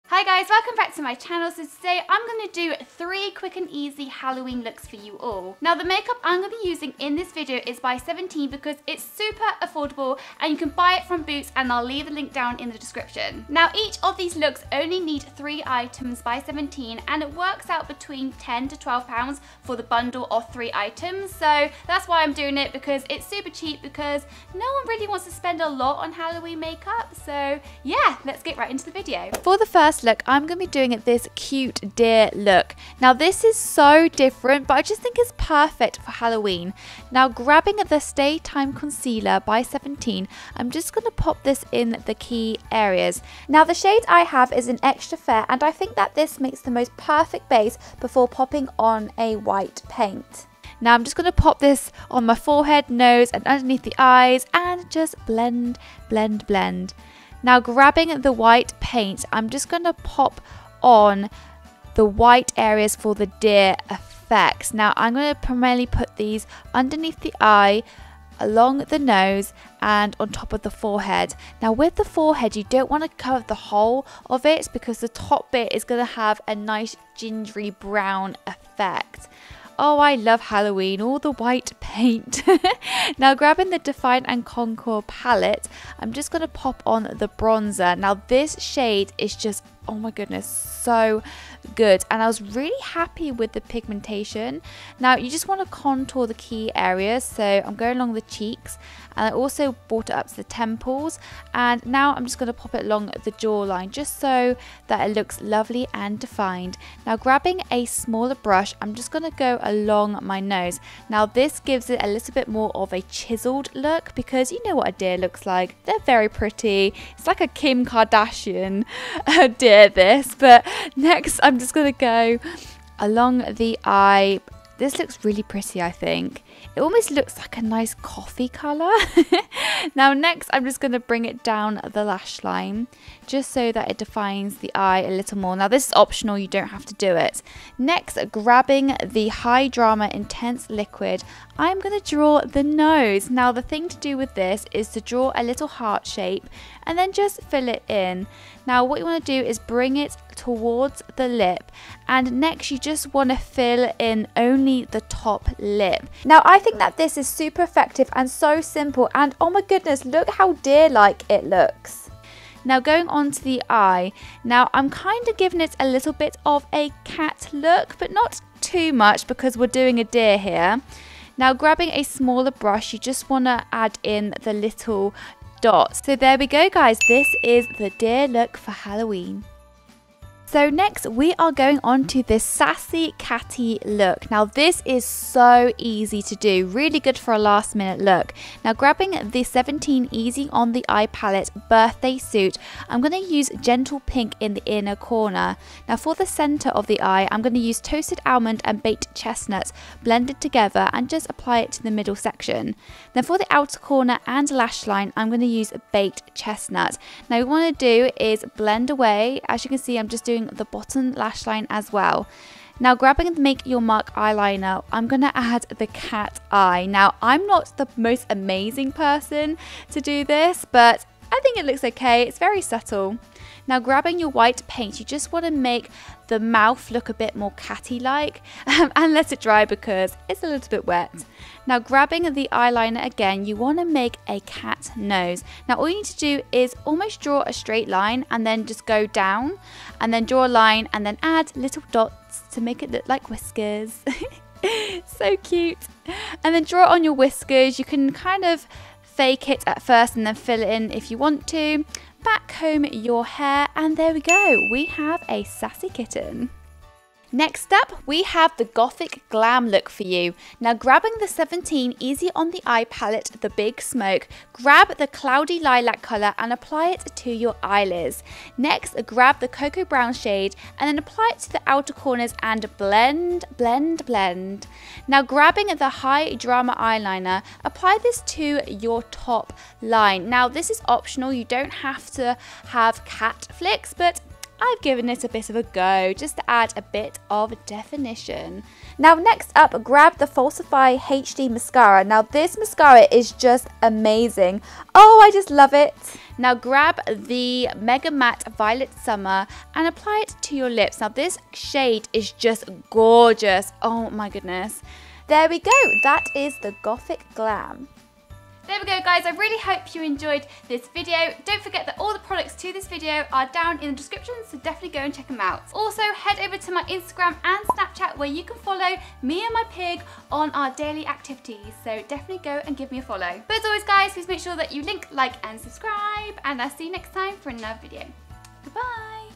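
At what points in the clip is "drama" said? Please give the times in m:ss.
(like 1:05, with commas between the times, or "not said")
2:19, 4:36.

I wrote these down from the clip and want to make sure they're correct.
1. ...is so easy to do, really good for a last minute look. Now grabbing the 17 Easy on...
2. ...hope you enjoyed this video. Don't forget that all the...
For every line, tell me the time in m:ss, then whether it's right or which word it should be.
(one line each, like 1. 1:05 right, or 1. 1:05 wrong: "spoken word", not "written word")
1. 3:04 right
2. 5:09 right.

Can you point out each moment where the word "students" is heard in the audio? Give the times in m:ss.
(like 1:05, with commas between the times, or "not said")
not said.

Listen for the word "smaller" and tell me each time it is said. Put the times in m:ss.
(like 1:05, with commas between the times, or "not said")
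1:47, 2:52.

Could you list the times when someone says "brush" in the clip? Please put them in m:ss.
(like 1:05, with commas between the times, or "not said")
1:48, 2:52.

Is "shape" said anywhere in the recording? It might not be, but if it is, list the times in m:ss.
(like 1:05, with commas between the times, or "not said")
2:26.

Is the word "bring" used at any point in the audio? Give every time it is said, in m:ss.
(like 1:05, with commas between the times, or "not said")
2:10, 2:29.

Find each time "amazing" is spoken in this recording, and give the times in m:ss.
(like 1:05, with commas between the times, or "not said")
3:38, 4:53.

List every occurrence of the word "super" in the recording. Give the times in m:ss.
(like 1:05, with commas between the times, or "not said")
0:09, 0:23, 2:37.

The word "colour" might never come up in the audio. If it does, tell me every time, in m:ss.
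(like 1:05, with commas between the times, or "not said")
2:08, 4:26.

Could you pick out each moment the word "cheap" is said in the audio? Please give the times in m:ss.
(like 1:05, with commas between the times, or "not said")
0:23.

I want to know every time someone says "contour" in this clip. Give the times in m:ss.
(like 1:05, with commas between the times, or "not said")
1:24, 1:35.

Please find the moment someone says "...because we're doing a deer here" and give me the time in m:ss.
2:49.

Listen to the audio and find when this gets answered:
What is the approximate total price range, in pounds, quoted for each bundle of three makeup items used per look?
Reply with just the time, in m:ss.
0:18.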